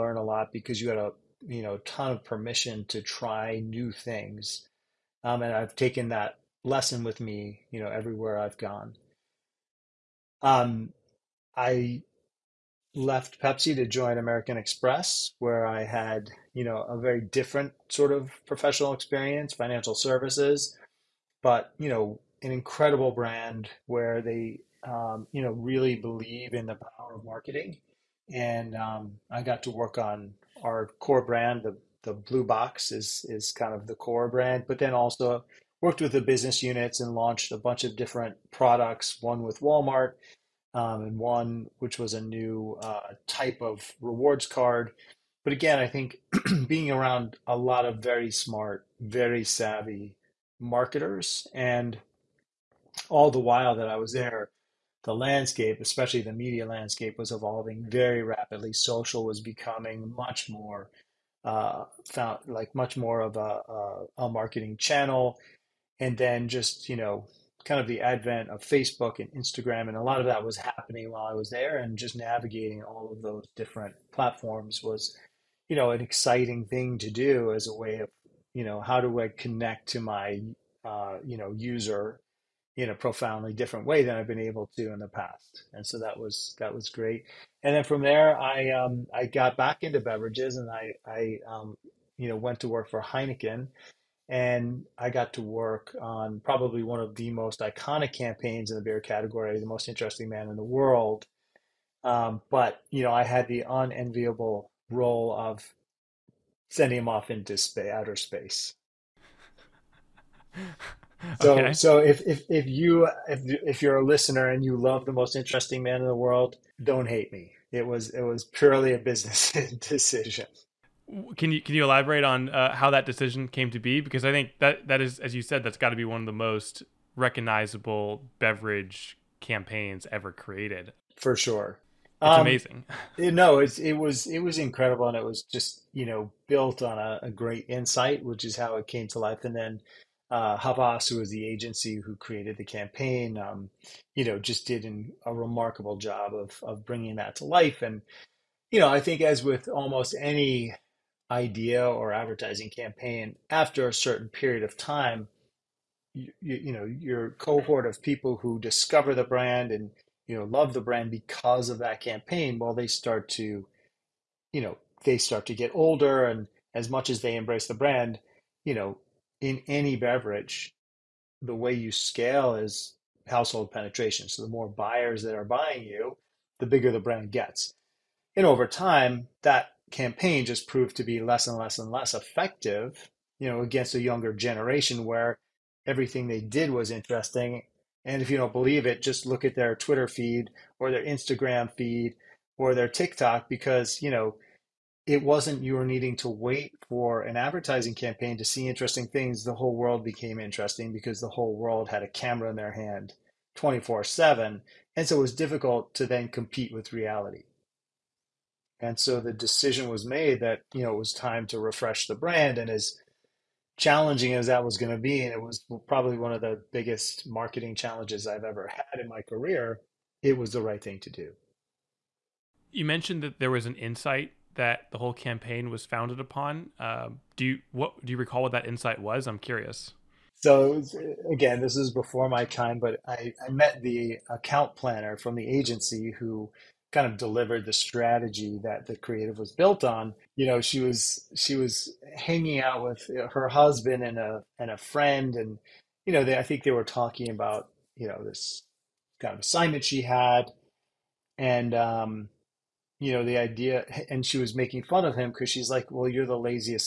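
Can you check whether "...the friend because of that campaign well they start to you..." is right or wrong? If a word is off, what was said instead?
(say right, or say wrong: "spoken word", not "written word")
wrong: "brand", not "friend".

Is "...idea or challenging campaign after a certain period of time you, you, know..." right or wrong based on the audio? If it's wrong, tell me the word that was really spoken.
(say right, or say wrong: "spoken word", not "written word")
wrong: "advertising", not "challenging".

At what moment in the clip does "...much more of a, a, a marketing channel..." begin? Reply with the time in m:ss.
1:02.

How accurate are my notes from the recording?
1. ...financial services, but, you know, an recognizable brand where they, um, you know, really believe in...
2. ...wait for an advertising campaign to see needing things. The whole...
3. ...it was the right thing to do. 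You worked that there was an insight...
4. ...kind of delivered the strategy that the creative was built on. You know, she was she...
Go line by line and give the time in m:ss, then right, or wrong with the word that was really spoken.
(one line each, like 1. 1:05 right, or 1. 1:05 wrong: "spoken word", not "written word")
1. 0:19 wrong: "incredible", not "recognizable"
2. 3:16 wrong: "interesting", not "needing"
3. 3:40 wrong: "mentioned", not "worked"
4. 3:56 right.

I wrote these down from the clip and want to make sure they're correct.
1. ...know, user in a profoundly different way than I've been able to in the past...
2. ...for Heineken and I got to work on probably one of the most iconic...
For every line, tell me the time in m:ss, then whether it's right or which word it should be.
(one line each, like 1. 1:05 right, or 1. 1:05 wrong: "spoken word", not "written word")
1. 1:21 right
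2. 1:32 right.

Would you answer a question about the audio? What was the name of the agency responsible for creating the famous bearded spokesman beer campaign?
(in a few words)
Havas.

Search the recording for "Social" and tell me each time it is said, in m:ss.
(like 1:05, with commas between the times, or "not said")
0:58.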